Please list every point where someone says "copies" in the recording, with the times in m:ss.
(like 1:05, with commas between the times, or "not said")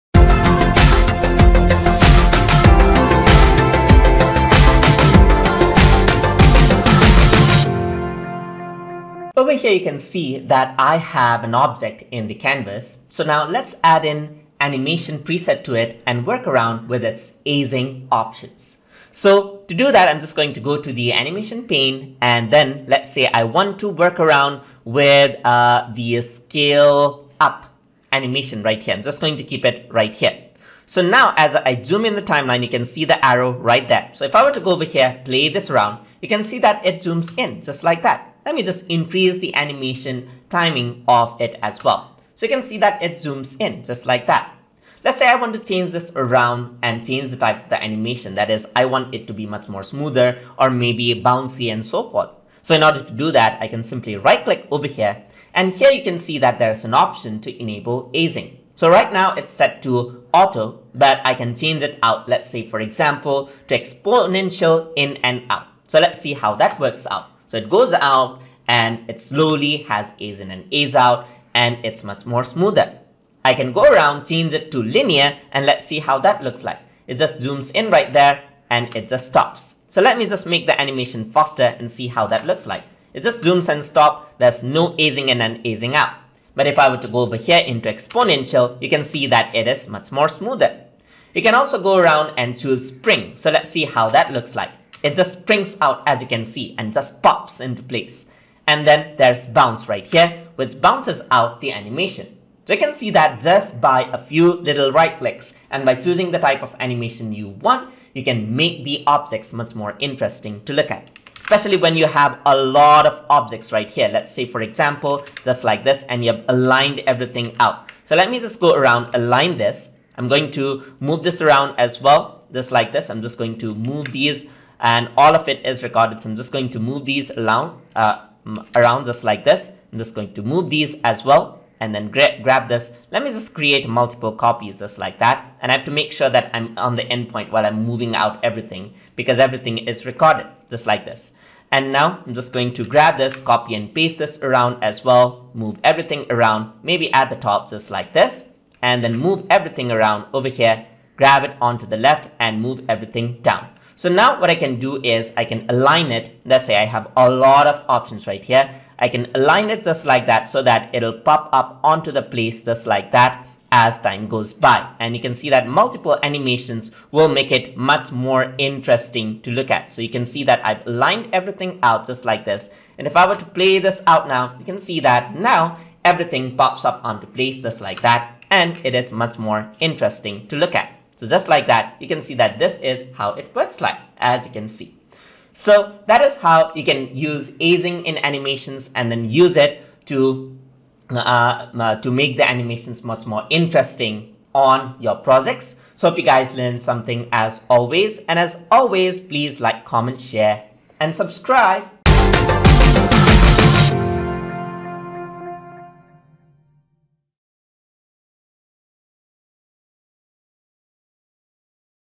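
2:14.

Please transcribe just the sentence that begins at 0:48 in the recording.
That is, I want it to be much more smoother or maybe bouncy and so forth.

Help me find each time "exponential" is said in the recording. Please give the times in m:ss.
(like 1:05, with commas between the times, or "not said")
1:03, 1:27.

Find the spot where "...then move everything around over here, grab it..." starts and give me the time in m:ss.
2:29.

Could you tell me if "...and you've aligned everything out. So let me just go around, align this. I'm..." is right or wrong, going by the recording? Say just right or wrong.
right.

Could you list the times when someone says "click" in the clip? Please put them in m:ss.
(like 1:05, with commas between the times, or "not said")
0:54, 1:45.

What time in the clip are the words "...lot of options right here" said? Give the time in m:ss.
2:37.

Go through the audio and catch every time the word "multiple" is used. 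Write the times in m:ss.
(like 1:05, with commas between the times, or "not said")
2:13, 2:45.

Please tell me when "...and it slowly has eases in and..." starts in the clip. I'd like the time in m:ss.
1:08.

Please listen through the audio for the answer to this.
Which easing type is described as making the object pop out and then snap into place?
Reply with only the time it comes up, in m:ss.
1:32.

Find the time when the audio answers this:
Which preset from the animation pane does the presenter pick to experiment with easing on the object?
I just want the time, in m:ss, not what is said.
0:26.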